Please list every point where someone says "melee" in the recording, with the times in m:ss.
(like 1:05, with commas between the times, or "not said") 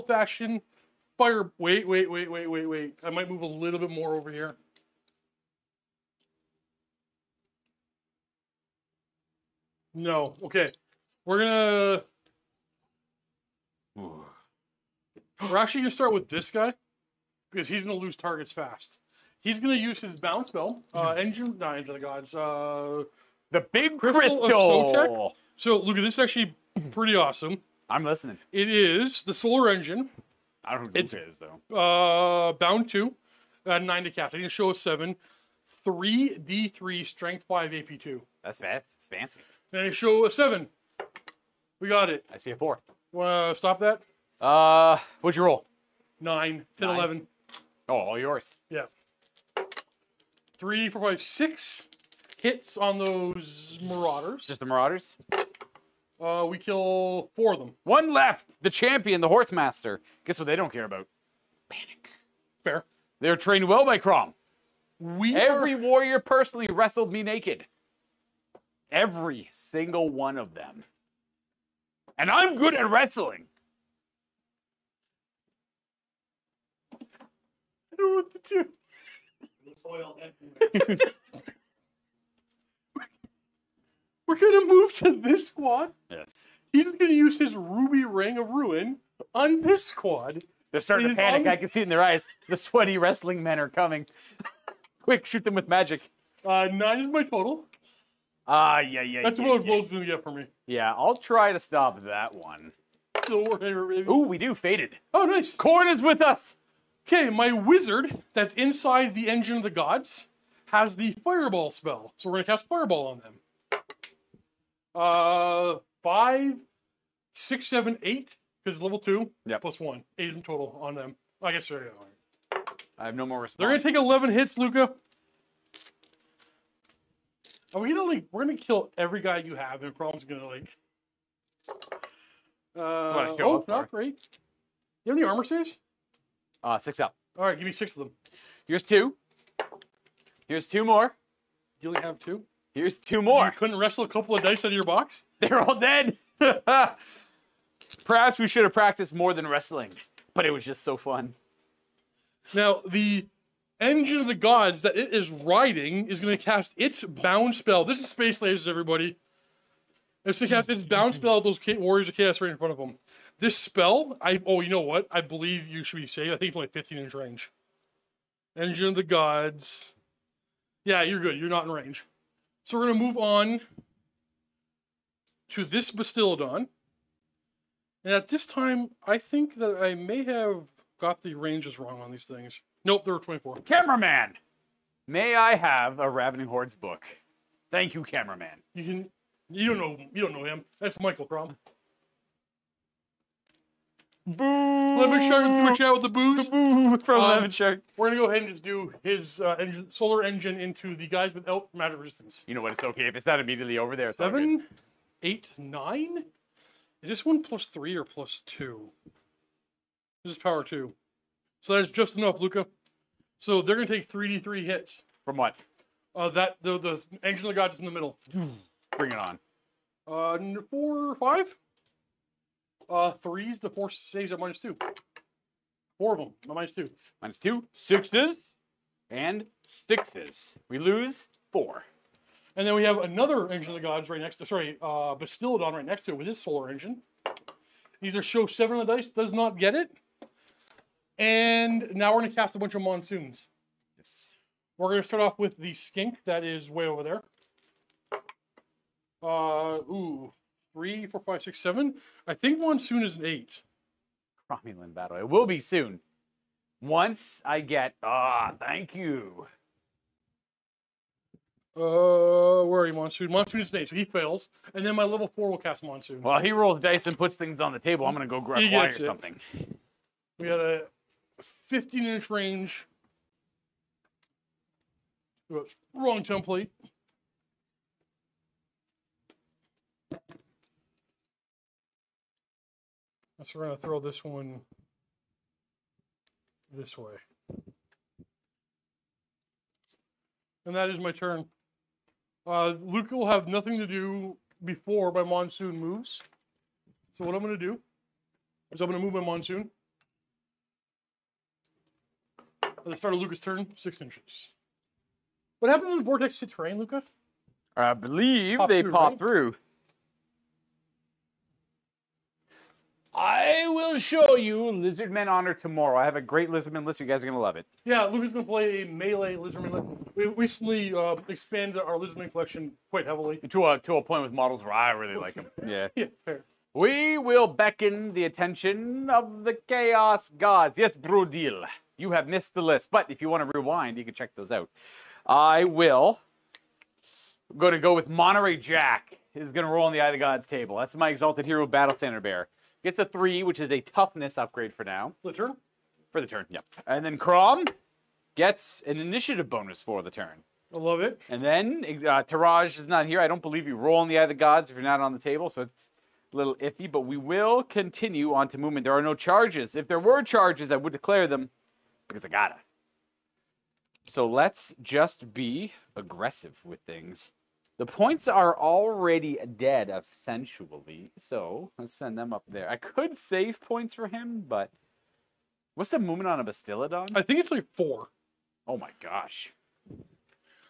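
5:18.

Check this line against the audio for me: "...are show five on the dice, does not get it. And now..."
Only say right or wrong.
wrong.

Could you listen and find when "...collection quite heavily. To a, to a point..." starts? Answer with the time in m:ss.
5:22.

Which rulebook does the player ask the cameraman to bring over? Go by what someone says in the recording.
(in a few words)
Ravening Hordes.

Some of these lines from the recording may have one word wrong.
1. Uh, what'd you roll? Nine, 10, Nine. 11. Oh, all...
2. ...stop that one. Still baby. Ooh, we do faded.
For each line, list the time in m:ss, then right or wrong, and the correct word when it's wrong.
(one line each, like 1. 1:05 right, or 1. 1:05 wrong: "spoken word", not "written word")
1. 0:44 right
2. 1:41 right.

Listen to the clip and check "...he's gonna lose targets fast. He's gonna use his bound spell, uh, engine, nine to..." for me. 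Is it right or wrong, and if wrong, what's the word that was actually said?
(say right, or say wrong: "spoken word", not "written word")
right.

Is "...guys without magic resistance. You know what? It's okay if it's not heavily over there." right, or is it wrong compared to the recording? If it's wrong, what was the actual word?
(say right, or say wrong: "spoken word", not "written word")
wrong: "immediately", not "heavily".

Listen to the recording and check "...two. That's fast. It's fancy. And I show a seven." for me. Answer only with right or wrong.
right.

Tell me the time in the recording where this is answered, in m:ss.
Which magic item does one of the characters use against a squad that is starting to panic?
1:27.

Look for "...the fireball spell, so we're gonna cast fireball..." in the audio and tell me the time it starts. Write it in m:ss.
1:50.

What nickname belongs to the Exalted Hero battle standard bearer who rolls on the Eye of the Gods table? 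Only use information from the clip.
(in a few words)
Monterey Jack.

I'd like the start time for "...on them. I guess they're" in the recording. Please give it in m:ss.
2:00.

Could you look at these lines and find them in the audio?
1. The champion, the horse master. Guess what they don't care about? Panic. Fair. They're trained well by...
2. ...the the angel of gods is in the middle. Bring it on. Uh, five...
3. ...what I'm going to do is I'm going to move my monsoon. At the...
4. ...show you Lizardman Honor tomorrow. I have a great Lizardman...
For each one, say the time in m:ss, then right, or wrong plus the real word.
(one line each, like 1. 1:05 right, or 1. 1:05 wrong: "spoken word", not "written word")
1. 0:58 right
2. 3:36 wrong: "four", not "five"
3. 4:57 right
4. 5:13 right.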